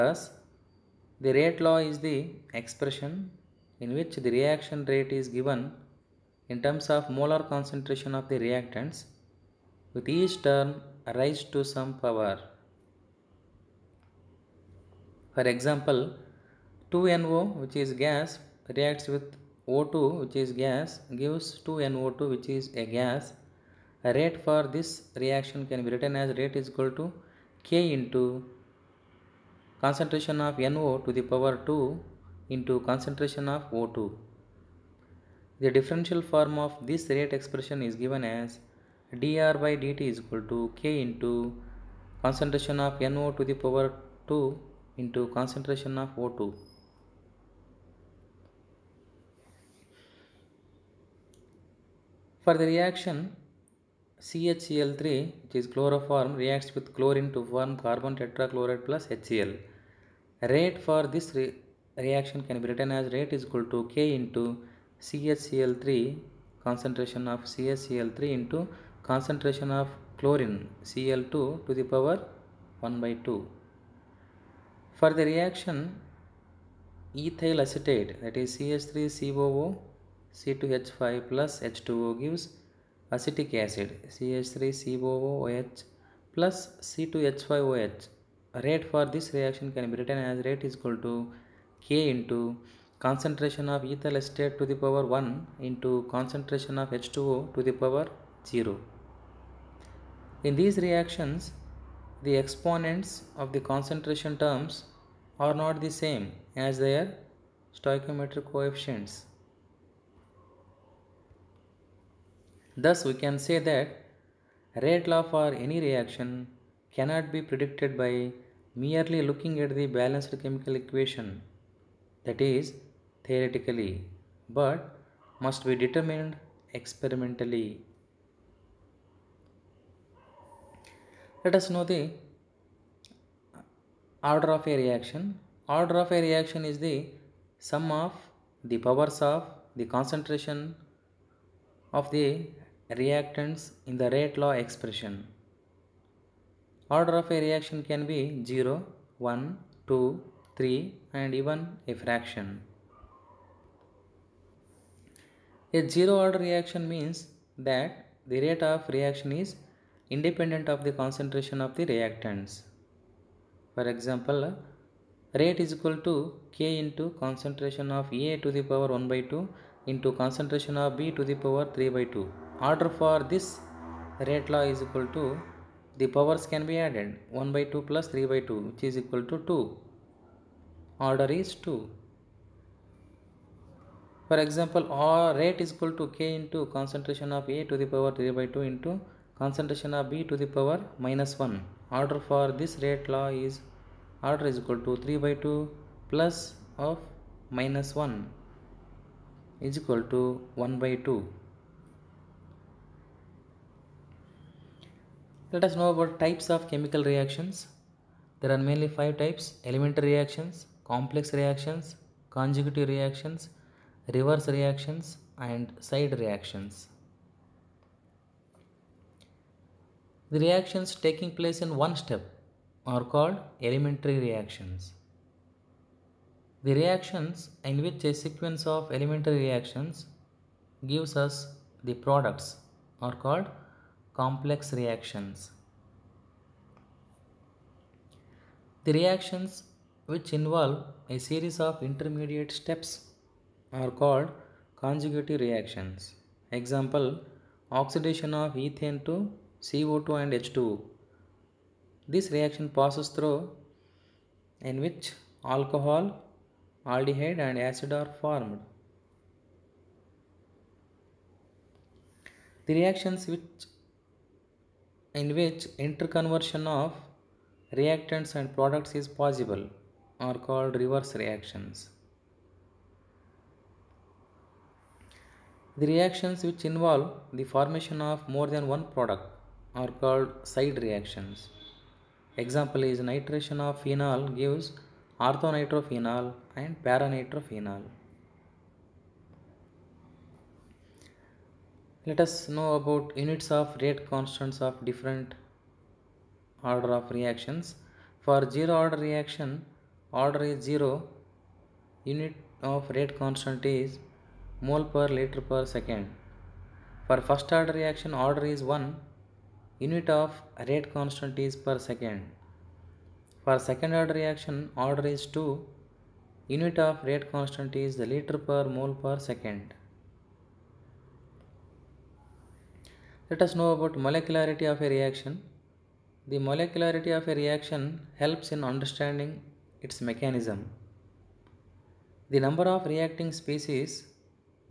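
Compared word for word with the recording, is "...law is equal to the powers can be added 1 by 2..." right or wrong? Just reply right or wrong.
right.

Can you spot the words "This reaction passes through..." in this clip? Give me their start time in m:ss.
4:12.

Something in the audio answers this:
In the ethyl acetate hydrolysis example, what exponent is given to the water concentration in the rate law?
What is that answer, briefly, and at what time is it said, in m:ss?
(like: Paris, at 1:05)
0, at 1:37.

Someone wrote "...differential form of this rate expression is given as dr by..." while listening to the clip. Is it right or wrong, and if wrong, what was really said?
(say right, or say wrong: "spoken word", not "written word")
right.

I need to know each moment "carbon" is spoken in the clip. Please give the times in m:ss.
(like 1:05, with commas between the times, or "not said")
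0:57.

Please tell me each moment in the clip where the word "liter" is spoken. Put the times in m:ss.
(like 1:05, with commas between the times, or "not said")
5:05, 5:17.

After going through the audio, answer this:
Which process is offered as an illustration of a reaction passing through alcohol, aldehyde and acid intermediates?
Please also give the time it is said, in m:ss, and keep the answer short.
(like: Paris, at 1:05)
oxidation of ethane, at 4:07.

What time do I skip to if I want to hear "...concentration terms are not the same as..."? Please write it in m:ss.
1:43.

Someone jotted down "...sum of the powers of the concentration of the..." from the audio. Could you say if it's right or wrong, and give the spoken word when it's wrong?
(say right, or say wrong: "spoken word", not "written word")
right.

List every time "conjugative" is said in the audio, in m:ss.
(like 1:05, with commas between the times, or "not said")
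3:32, 4:04.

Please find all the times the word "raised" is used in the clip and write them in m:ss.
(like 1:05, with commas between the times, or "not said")
0:11.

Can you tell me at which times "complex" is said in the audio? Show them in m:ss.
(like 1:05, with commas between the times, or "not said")
3:30, 3:54.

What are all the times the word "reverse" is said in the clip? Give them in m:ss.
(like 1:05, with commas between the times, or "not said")
3:34, 4:30.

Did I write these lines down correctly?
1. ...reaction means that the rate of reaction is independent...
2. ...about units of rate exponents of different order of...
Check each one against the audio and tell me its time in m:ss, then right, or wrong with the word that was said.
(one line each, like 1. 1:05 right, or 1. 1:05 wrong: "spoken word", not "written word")
1. 2:36 right
2. 4:52 wrong: "constants", not "exponents".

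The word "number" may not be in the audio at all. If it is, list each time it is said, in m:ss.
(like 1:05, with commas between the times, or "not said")
5:32.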